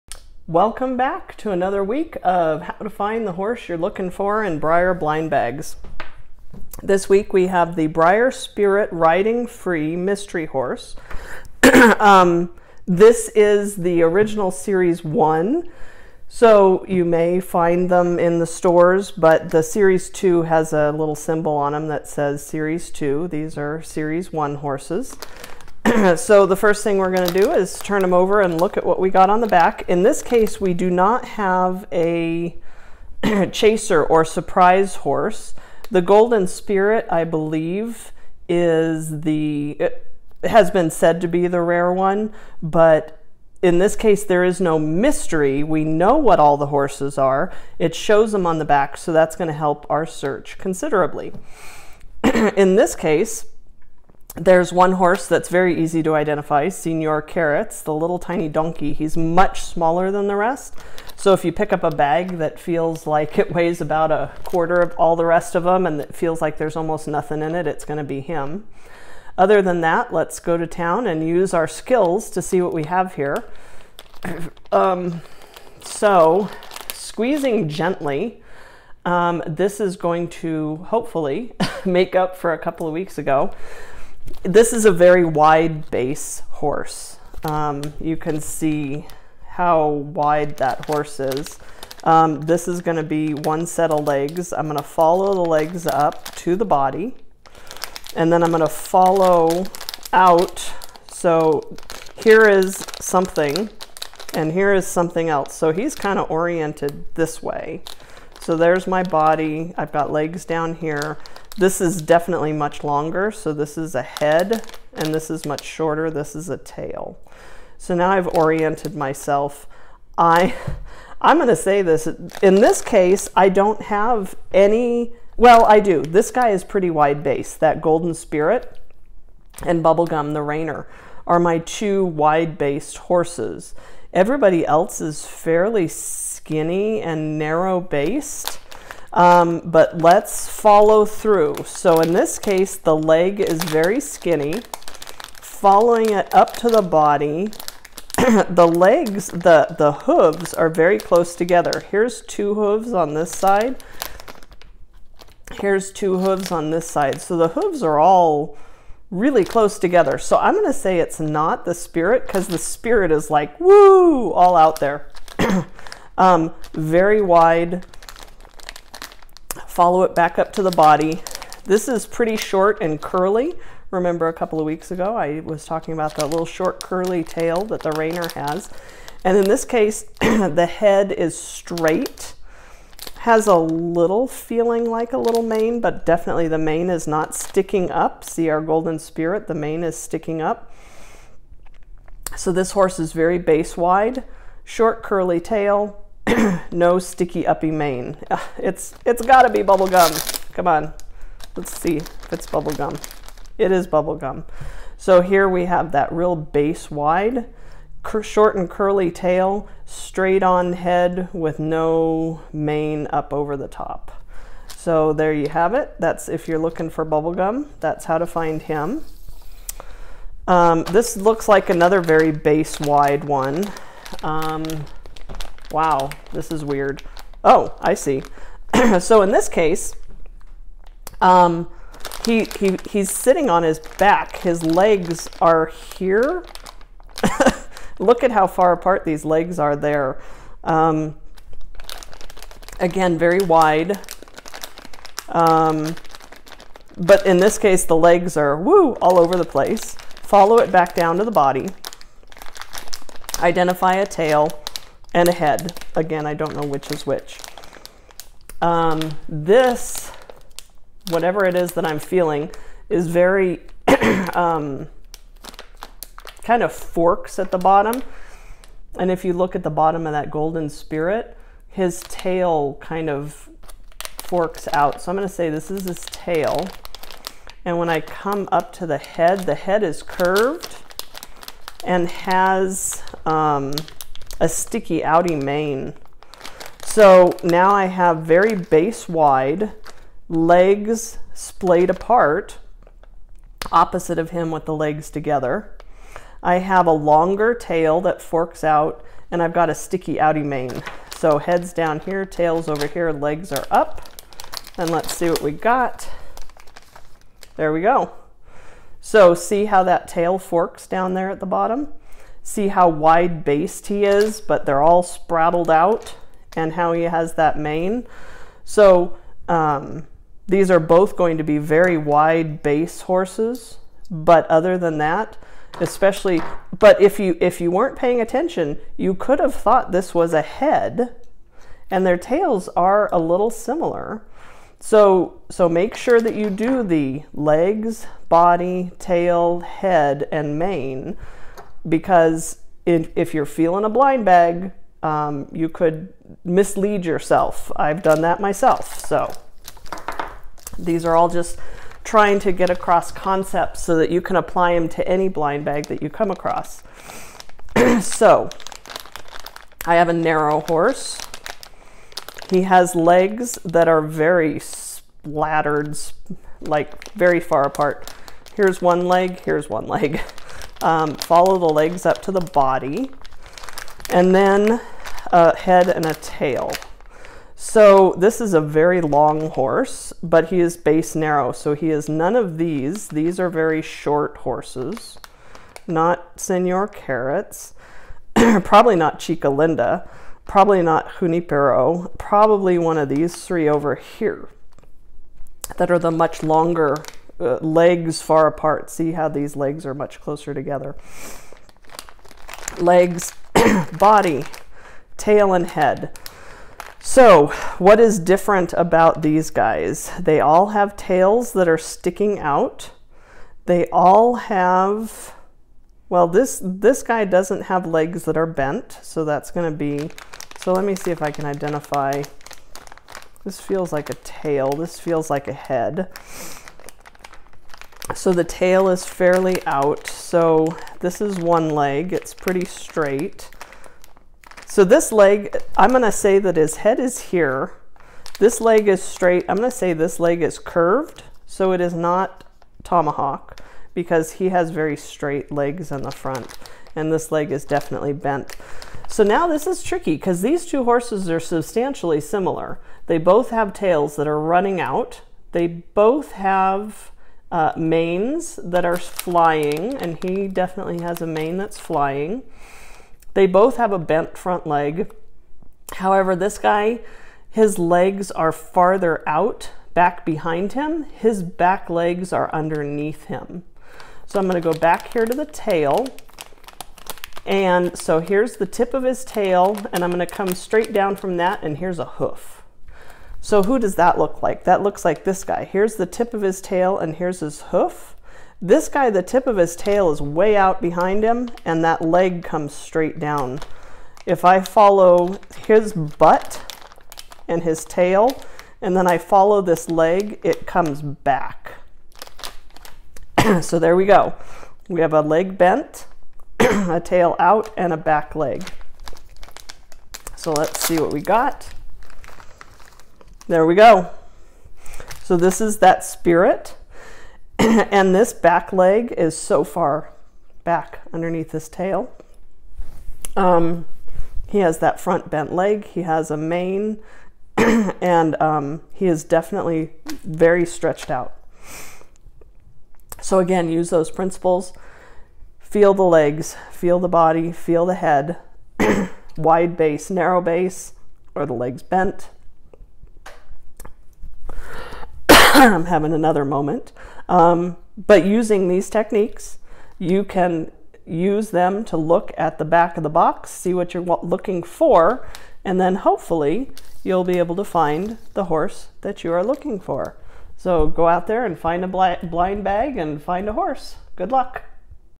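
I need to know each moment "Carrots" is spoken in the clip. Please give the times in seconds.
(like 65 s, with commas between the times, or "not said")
57 s, 386 s.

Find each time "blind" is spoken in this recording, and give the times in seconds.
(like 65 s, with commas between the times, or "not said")
4 s, 343 s, 355 s, 562 s.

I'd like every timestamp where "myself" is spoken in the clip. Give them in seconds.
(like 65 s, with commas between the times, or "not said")
118 s, 348 s.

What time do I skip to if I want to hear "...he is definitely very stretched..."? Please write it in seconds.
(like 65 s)
528 s.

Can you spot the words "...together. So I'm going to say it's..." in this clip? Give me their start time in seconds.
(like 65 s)
159 s.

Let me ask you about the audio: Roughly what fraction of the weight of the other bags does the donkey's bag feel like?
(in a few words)
a quarter.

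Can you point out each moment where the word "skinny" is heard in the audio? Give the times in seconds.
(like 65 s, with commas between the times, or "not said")
135 s, 143 s.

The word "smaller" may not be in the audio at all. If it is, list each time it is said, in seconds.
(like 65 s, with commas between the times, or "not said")
59 s.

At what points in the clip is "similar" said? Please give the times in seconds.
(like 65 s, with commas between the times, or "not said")
333 s, 452 s.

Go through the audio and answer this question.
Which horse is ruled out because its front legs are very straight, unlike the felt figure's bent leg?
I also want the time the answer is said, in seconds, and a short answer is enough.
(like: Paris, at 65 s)
Tomahawk, at 442 s.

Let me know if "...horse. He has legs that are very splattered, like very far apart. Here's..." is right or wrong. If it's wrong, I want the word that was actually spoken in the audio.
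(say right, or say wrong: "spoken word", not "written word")
right.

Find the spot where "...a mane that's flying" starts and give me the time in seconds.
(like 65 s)
461 s.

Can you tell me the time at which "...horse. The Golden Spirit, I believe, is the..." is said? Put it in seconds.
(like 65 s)
34 s.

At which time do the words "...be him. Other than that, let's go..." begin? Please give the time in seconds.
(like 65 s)
68 s.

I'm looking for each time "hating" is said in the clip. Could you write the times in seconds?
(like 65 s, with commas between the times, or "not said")
not said.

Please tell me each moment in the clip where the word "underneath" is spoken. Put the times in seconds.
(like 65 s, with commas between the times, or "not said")
472 s, 521 s.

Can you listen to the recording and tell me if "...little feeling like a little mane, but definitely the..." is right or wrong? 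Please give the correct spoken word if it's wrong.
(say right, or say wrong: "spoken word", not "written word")
right.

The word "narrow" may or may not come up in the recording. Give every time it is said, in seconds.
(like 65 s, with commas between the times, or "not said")
137 s, 360 s, 381 s, 540 s.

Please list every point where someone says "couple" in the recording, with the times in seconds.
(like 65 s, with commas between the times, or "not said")
82 s, 174 s.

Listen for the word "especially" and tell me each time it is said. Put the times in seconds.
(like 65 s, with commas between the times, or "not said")
325 s.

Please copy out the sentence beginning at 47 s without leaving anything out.
It shows them on the back, so that's going to help our search considerably.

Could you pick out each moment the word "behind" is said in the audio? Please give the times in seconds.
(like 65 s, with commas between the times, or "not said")
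470 s, 490 s.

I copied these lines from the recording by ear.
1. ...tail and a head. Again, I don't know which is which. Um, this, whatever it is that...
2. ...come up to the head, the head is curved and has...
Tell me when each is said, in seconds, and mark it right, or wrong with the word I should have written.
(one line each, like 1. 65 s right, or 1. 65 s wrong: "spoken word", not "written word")
1. 254 s right
2. 278 s right.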